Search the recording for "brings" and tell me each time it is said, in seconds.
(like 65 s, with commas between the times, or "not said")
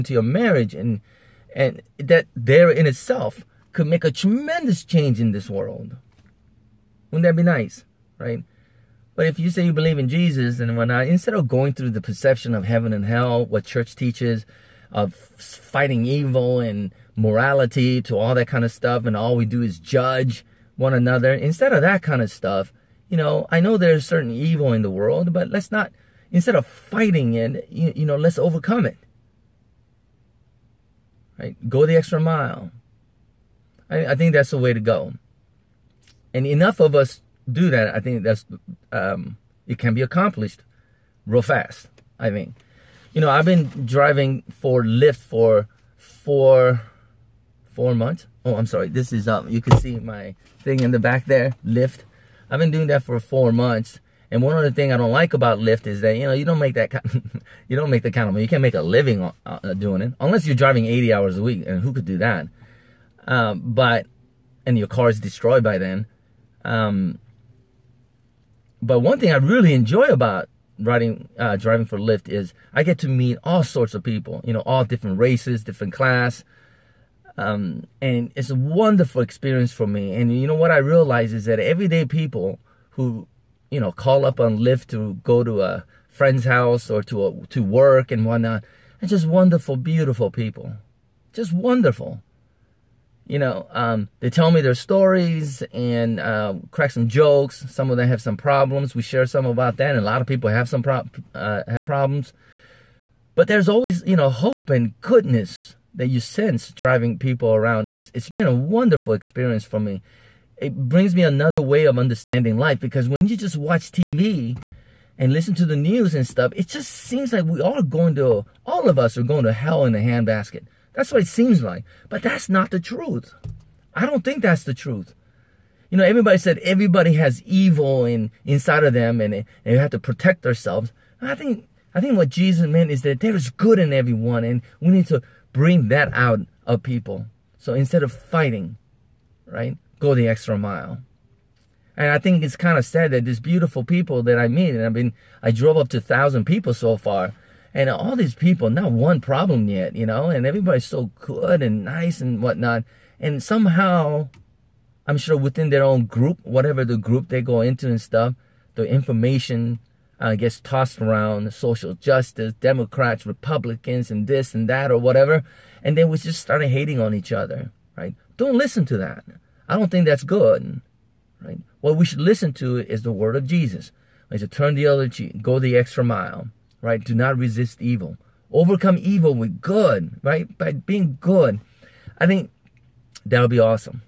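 110 s, 135 s.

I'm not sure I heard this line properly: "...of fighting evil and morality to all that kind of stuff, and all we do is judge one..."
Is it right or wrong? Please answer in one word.
right.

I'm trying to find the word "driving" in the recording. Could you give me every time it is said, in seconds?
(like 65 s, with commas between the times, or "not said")
43 s, 60 s, 71 s, 106 s.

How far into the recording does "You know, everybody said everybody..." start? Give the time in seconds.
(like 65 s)
125 s.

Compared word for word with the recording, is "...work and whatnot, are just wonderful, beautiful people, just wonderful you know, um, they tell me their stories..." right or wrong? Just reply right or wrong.
right.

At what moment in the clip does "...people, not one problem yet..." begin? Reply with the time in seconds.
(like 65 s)
148 s.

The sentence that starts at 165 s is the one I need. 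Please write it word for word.
And then we just started hating on each other, right?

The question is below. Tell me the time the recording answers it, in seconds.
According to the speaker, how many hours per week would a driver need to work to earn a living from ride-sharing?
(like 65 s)
60 s.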